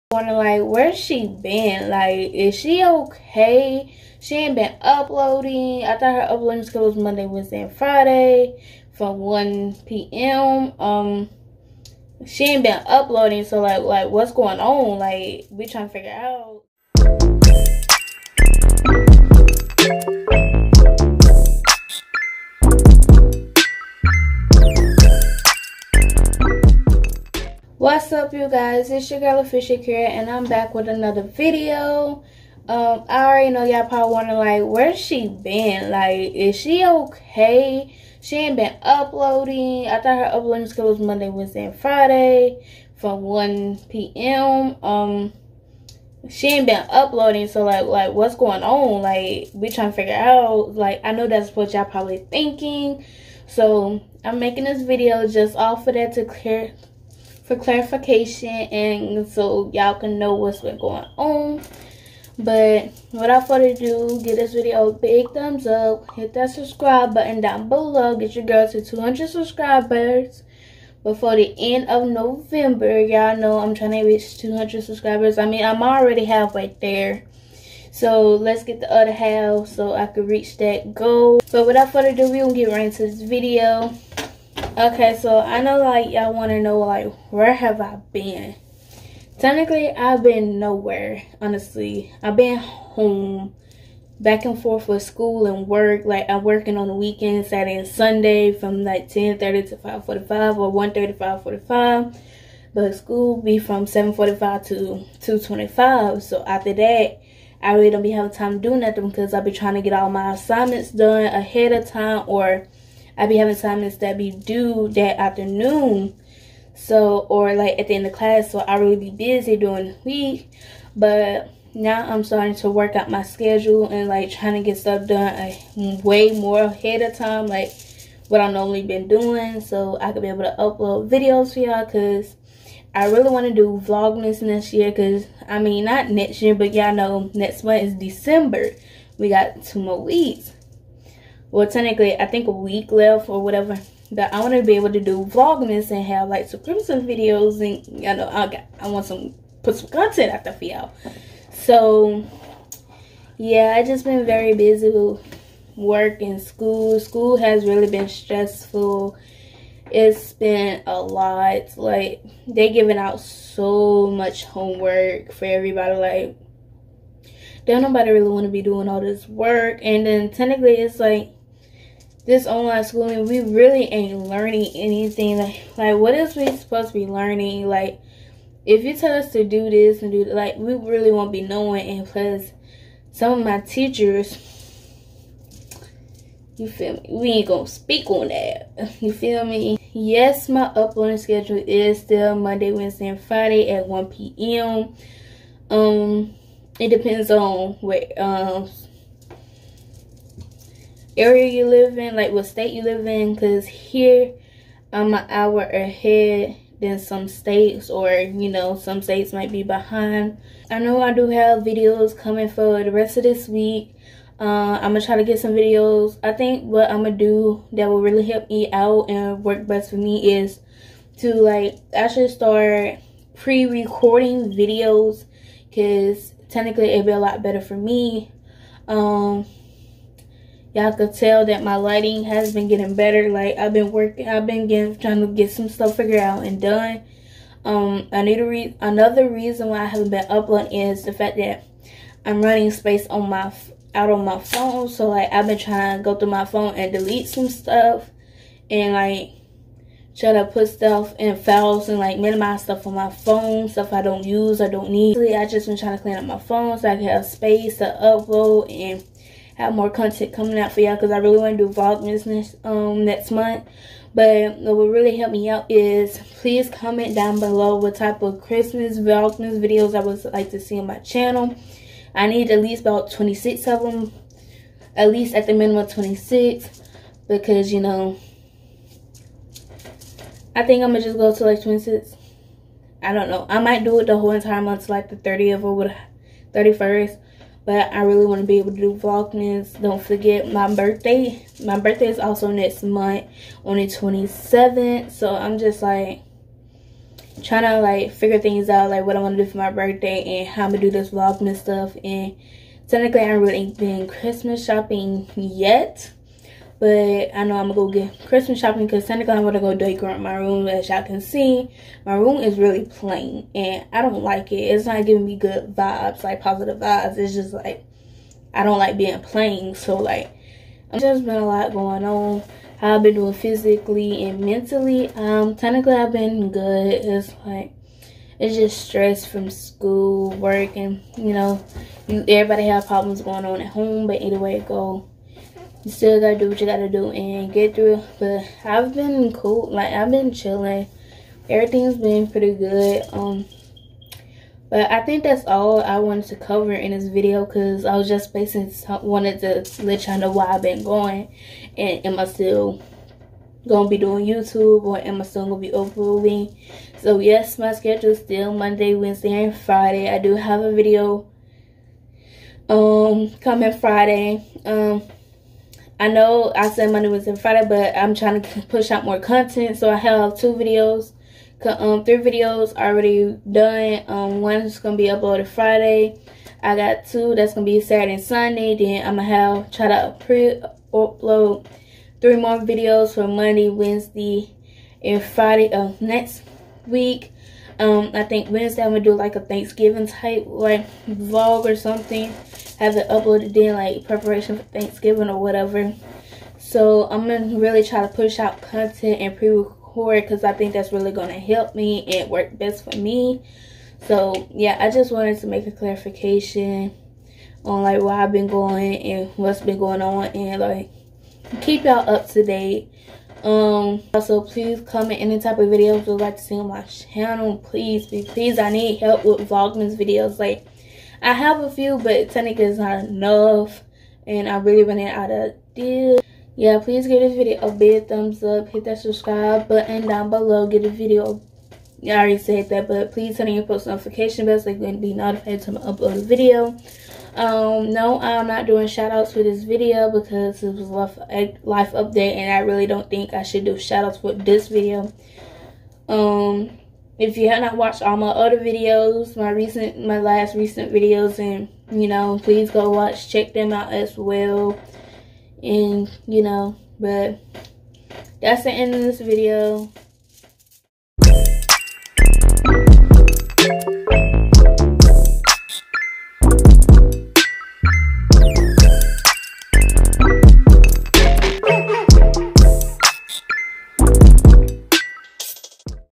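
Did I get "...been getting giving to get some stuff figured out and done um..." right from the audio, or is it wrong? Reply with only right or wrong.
wrong.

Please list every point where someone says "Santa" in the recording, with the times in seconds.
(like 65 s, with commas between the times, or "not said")
309 s.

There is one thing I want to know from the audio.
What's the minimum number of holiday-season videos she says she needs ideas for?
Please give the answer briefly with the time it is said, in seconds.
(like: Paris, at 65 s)
26, at 274 s.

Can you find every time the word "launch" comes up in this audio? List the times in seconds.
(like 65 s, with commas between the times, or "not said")
not said.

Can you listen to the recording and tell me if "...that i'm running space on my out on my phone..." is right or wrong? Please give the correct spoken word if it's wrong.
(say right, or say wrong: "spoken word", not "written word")
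right.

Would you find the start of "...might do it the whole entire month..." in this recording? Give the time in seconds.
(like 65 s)
283 s.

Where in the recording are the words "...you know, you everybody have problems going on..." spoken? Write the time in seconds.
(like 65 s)
331 s.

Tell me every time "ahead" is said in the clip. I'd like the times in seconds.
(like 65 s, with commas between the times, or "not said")
111 s, 126 s, 205 s.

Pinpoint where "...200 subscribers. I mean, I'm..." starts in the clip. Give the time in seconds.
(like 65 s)
74 s.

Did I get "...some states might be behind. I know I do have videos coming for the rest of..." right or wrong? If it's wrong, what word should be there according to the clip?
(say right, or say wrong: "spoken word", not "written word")
right.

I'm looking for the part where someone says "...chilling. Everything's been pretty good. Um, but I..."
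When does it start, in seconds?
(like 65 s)
340 s.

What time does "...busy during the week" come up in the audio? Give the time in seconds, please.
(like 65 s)
119 s.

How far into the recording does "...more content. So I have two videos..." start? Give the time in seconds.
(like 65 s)
369 s.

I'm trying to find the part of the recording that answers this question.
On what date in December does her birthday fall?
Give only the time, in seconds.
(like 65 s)
293 s.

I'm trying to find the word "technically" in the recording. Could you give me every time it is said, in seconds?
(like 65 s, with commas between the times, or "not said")
89 s, 141 s, 170 s, 226 s, 302 s, 325 s, 422 s.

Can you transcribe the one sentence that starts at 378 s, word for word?
Then I'm gonna have try to pre upload three more videos for Monday, Wednesday, and Friday of next week.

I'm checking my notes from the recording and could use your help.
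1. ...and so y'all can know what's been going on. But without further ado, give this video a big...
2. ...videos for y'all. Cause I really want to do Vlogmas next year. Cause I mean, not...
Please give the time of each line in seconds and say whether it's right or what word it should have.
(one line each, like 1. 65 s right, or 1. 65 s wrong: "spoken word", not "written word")
1. 58 s right
2. 131 s right.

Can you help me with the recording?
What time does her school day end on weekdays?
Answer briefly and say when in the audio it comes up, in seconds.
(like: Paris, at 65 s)
2:25, at 103 s.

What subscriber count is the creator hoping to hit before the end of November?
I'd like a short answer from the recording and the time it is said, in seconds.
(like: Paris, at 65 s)
200, at 68 s.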